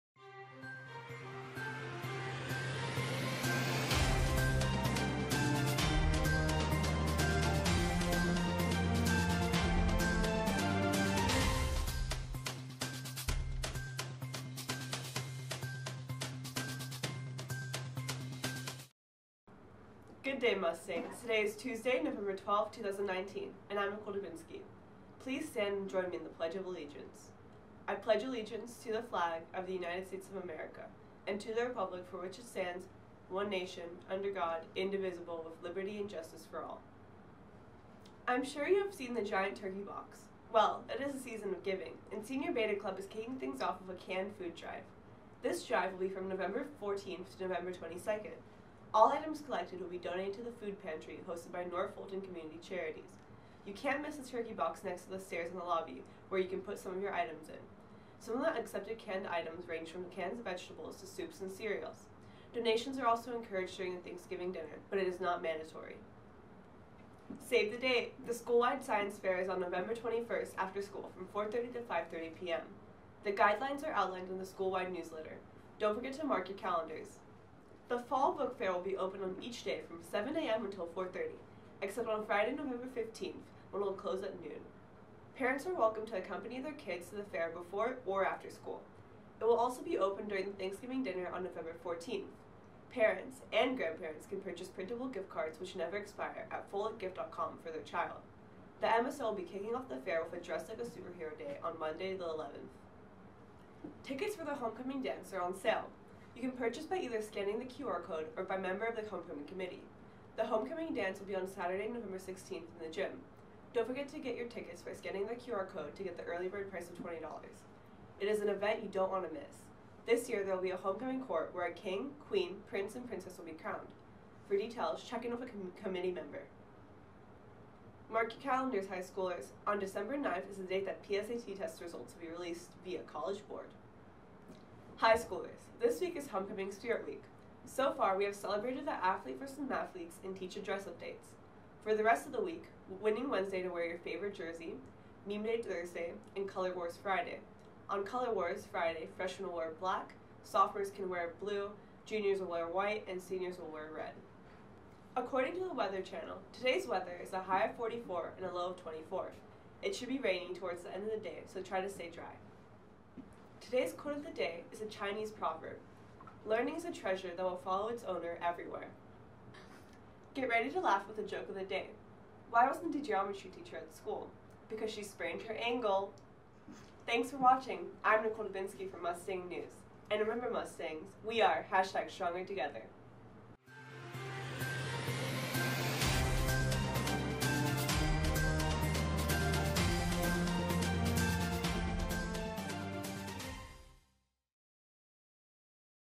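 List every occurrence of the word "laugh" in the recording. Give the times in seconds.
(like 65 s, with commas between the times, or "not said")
170 s.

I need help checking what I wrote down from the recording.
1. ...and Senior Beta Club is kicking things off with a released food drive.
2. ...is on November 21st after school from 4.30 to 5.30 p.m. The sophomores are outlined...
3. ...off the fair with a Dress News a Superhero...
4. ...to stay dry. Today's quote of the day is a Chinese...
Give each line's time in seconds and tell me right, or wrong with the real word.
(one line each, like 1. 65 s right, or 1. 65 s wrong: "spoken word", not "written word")
1. 42 s wrong: "canned", not "released"
2. 69 s wrong: "guidelines", not "sophomores"
3. 99 s wrong: "Like", not "News"
4. 161 s right.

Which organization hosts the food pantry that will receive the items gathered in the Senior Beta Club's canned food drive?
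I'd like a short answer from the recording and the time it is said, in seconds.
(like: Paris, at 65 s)
North Fulton Community Charities, at 51 s.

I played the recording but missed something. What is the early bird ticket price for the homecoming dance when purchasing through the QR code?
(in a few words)
$20.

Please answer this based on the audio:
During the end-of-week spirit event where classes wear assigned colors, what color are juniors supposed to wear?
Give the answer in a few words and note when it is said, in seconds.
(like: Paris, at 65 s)
White, at 152 s.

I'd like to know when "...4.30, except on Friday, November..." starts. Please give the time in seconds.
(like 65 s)
80 s.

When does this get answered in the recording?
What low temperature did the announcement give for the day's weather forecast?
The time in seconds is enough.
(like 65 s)
158 s.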